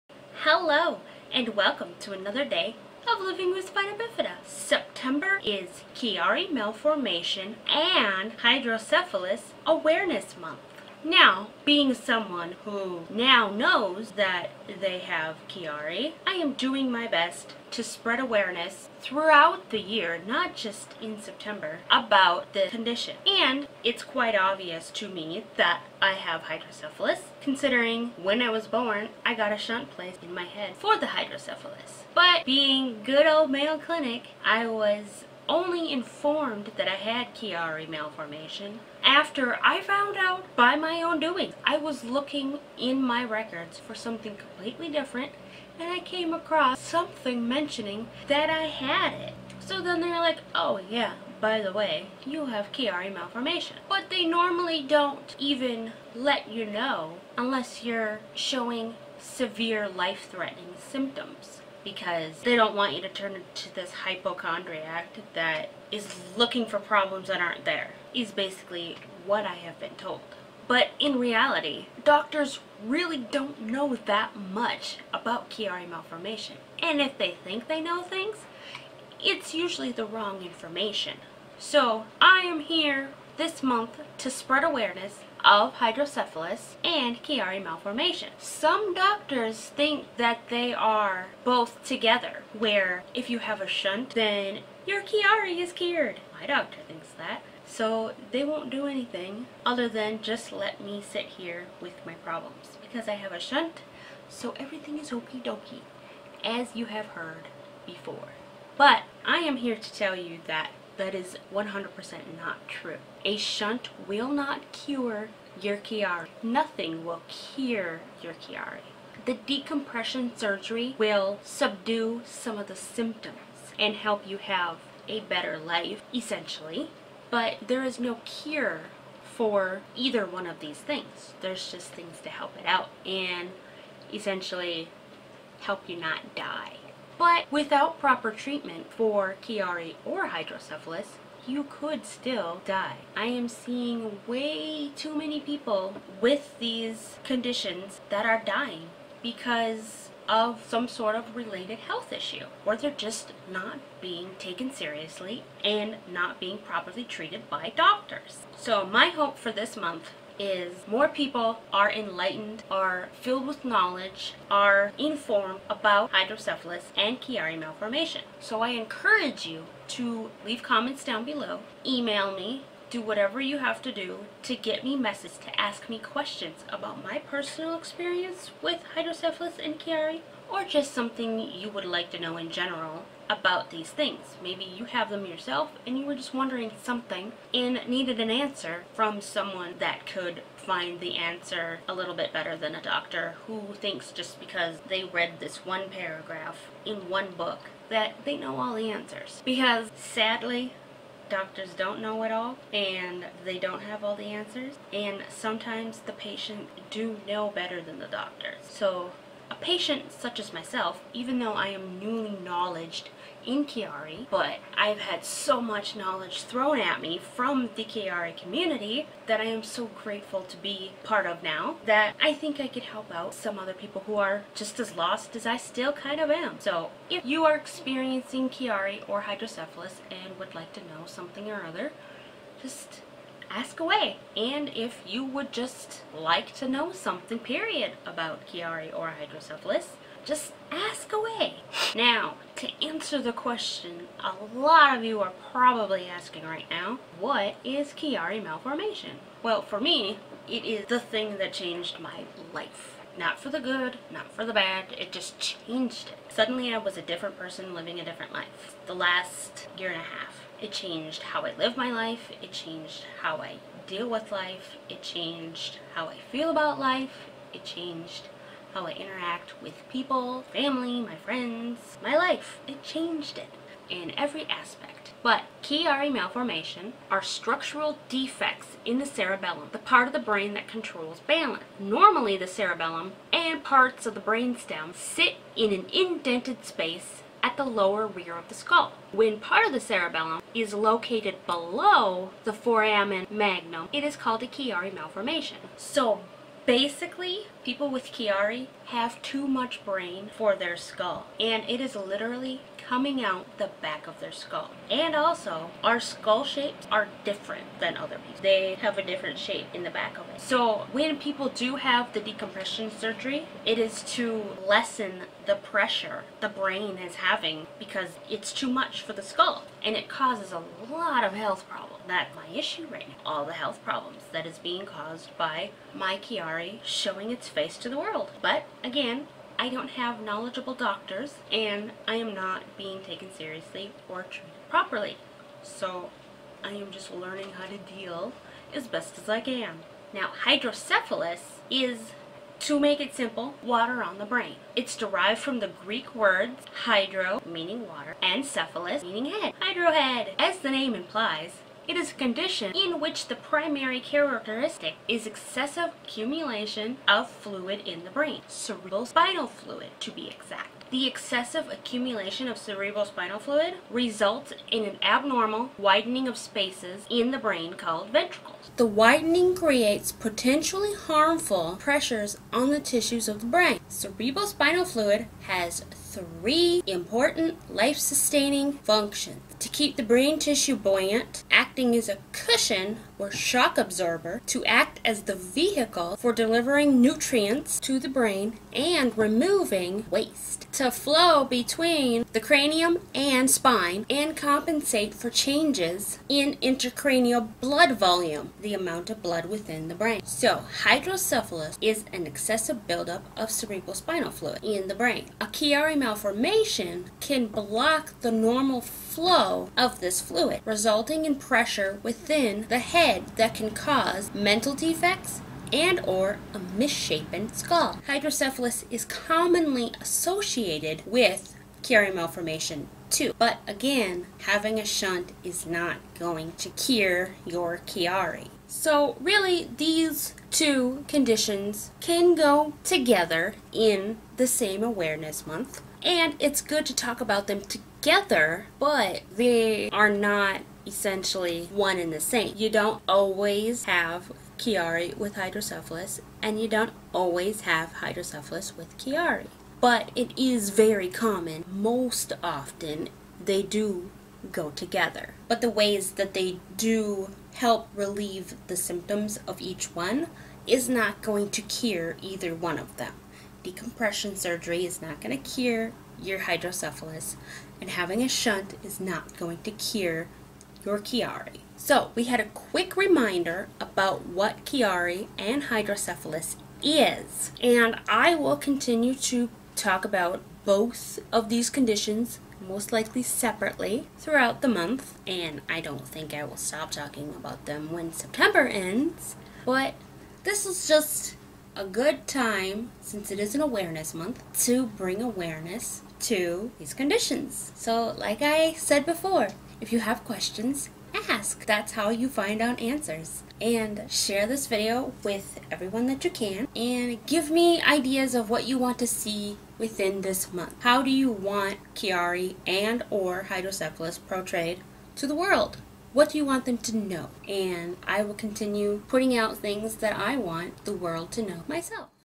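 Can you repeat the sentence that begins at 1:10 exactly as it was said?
But in reality, doctors really don't know that much about Chiari malformation.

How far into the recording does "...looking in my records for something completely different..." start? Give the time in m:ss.
0:42.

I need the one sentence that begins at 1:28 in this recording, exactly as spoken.
Some doctors think that they are both together, where if you have a shunt, then your Chiari is cured.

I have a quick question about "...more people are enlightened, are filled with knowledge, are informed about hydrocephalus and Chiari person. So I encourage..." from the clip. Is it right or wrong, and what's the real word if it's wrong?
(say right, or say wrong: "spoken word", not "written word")
wrong: "malformation", not "person".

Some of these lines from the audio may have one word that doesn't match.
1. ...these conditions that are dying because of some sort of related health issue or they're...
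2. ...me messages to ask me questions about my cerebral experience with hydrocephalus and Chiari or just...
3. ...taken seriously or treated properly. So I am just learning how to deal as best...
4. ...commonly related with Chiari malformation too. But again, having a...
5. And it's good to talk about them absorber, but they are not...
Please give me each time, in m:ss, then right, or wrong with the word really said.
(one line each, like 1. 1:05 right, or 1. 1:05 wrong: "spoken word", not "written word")
1. 2:26 right
2. 2:54 wrong: "personal", not "cerebral"
3. 5:33 right
4. 6:59 wrong: "associated", not "related"
5. 7:16 wrong: "together", not "absorber".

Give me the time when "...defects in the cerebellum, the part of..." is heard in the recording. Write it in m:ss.
4:38.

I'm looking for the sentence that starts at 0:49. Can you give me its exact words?
So then they're like, oh yeah, by the way, you have Chiari malformation.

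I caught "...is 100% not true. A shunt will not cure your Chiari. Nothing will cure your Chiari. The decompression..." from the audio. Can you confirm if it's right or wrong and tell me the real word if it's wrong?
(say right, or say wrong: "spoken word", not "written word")
right.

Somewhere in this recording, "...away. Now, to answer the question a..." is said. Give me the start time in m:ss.
4:01.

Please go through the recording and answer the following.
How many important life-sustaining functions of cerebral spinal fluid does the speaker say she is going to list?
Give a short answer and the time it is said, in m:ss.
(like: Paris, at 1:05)
3, at 6:16.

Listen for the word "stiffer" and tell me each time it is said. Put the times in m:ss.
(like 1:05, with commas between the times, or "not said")
not said.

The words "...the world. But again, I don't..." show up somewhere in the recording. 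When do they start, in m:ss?
5:27.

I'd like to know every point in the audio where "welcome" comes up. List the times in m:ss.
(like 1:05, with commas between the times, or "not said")
0:01.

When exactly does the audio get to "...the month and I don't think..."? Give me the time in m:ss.
8:04.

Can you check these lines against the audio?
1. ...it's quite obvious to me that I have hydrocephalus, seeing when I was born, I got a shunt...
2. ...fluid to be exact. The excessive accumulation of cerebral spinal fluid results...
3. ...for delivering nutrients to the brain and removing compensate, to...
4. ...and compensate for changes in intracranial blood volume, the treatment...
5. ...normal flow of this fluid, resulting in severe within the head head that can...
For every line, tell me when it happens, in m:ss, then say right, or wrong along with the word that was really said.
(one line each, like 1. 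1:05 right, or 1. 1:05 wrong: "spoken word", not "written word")
1. 0:23 wrong: "considering", not "seeing"
2. 5:59 right
3. 6:26 wrong: "waste", not "compensate"
4. 6:34 wrong: "amount", not "treatment"
5. 6:48 wrong: "pressure", not "severe".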